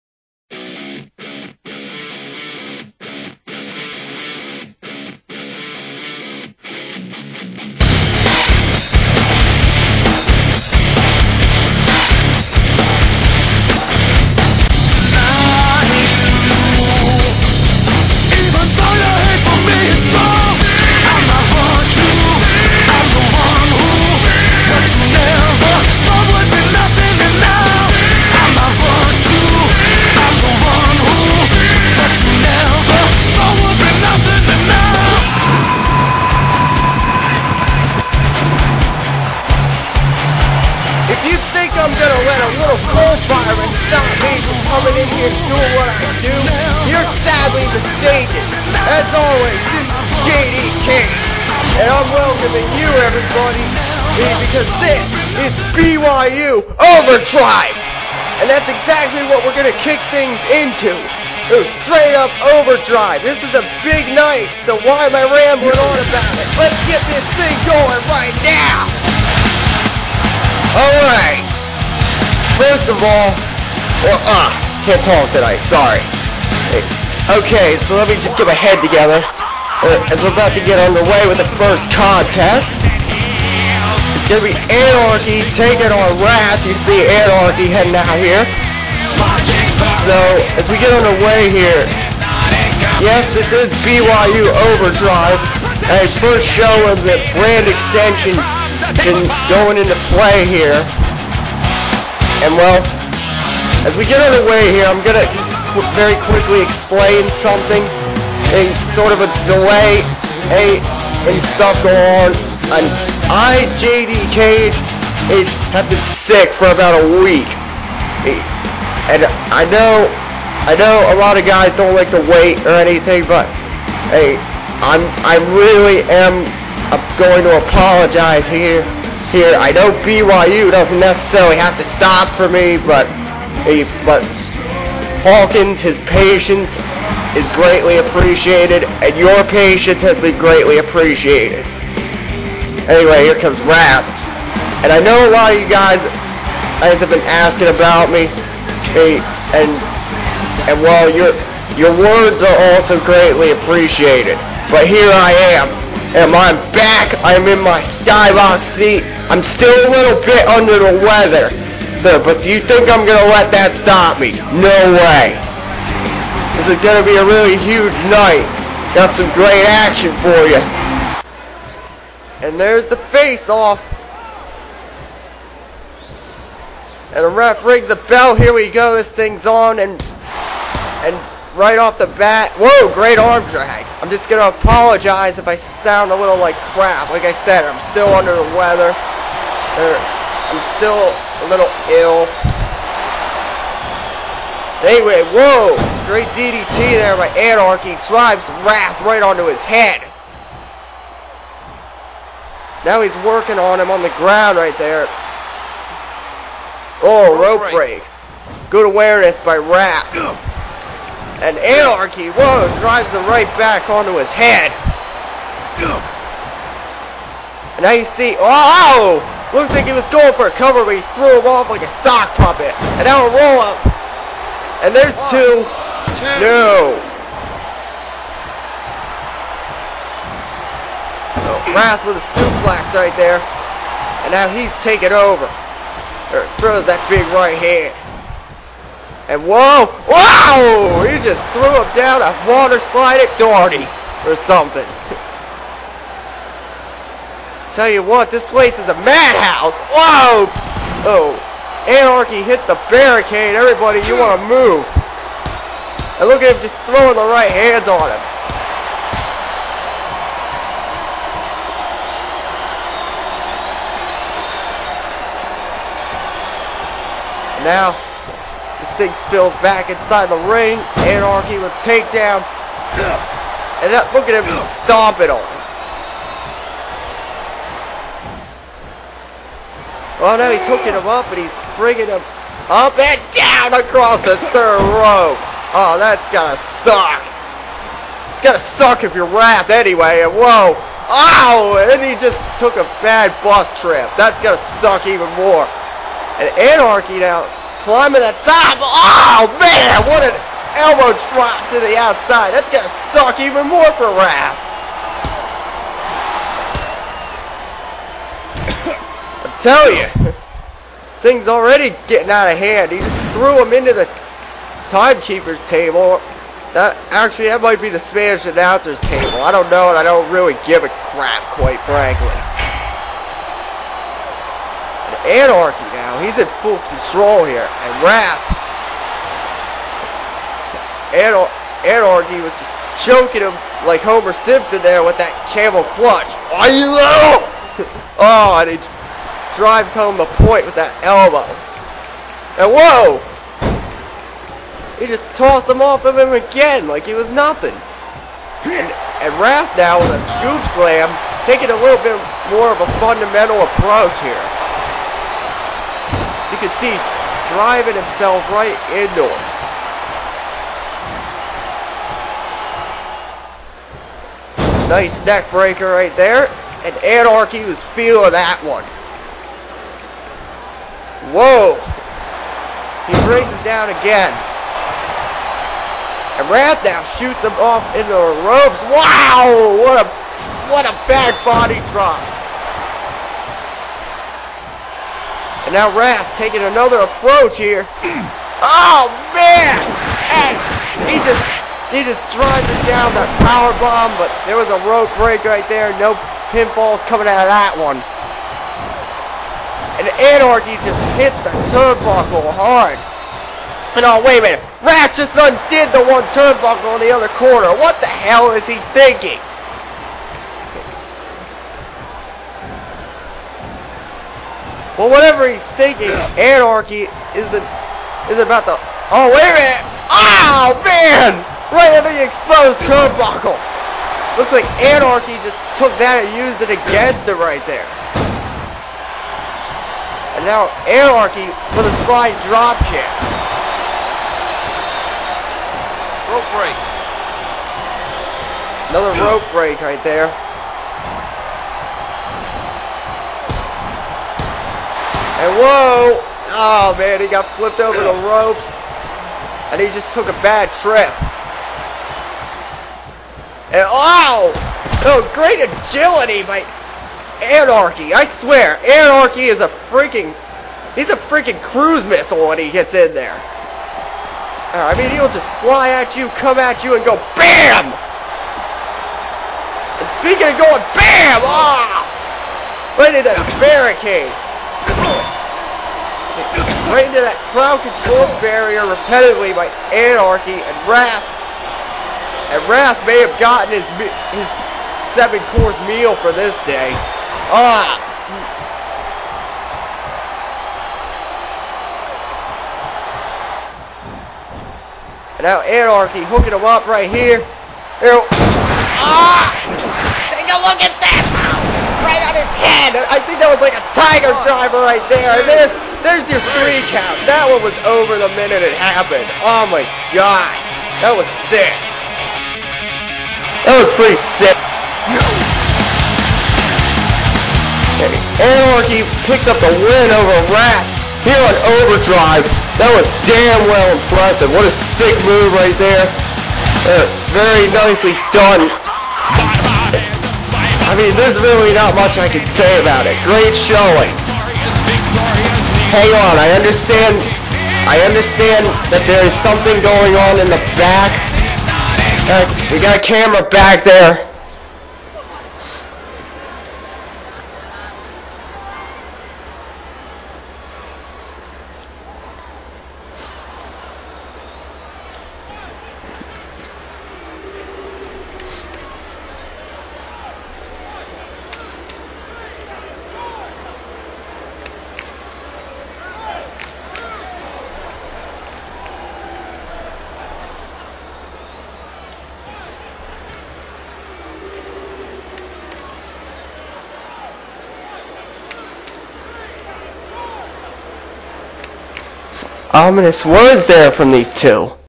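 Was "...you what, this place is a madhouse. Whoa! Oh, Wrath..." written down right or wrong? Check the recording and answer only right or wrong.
wrong.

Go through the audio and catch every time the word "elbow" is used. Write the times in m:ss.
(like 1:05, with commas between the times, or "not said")
5:00, 5:41.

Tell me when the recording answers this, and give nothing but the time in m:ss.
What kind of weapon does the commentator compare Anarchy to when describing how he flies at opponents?
7:41.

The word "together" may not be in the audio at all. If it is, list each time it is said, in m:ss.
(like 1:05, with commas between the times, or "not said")
1:18.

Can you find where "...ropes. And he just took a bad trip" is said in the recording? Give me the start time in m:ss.
7:28.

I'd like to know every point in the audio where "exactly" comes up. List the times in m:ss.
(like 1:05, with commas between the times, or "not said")
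0:58.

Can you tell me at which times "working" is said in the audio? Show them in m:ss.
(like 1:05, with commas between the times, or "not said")
3:23.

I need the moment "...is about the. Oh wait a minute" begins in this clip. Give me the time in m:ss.
6:58.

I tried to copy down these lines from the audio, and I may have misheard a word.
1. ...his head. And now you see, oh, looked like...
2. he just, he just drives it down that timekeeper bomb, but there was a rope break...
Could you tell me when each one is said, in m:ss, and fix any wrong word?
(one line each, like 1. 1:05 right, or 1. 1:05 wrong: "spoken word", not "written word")
1. 3:34 right
2. 6:31 wrong: "power", not "timekeeper".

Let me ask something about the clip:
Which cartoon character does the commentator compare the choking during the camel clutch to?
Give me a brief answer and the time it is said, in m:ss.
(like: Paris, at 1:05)
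Homer Simpson, at 5:34.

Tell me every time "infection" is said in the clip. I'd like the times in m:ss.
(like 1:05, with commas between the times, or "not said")
not said.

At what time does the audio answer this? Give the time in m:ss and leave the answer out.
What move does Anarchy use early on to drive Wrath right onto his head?
3:16.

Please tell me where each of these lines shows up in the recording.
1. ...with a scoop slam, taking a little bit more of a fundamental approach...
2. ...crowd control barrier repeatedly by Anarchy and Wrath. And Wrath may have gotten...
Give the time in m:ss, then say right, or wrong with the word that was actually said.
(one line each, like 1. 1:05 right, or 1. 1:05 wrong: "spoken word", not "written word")
1. 5:49 right
2. 7:57 right.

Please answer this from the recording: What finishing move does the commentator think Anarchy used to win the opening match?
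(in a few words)
Tiger driver.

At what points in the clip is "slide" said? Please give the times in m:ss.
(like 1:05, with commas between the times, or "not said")
4:02, 7:12.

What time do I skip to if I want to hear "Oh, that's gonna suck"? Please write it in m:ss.
4:45.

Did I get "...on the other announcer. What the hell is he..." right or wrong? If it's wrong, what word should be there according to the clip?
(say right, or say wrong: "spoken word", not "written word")
wrong: "corner", not "announcer".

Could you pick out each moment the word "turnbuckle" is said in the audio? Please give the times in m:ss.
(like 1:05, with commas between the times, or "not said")
6:41, 6:46, 7:02.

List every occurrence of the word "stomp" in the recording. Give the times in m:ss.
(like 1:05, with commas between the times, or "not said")
4:34.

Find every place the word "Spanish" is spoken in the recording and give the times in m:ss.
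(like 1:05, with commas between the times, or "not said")
5:17.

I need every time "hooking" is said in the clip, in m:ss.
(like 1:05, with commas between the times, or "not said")
4:40, 8:16.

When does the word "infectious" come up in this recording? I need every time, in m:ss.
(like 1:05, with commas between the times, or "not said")
not said.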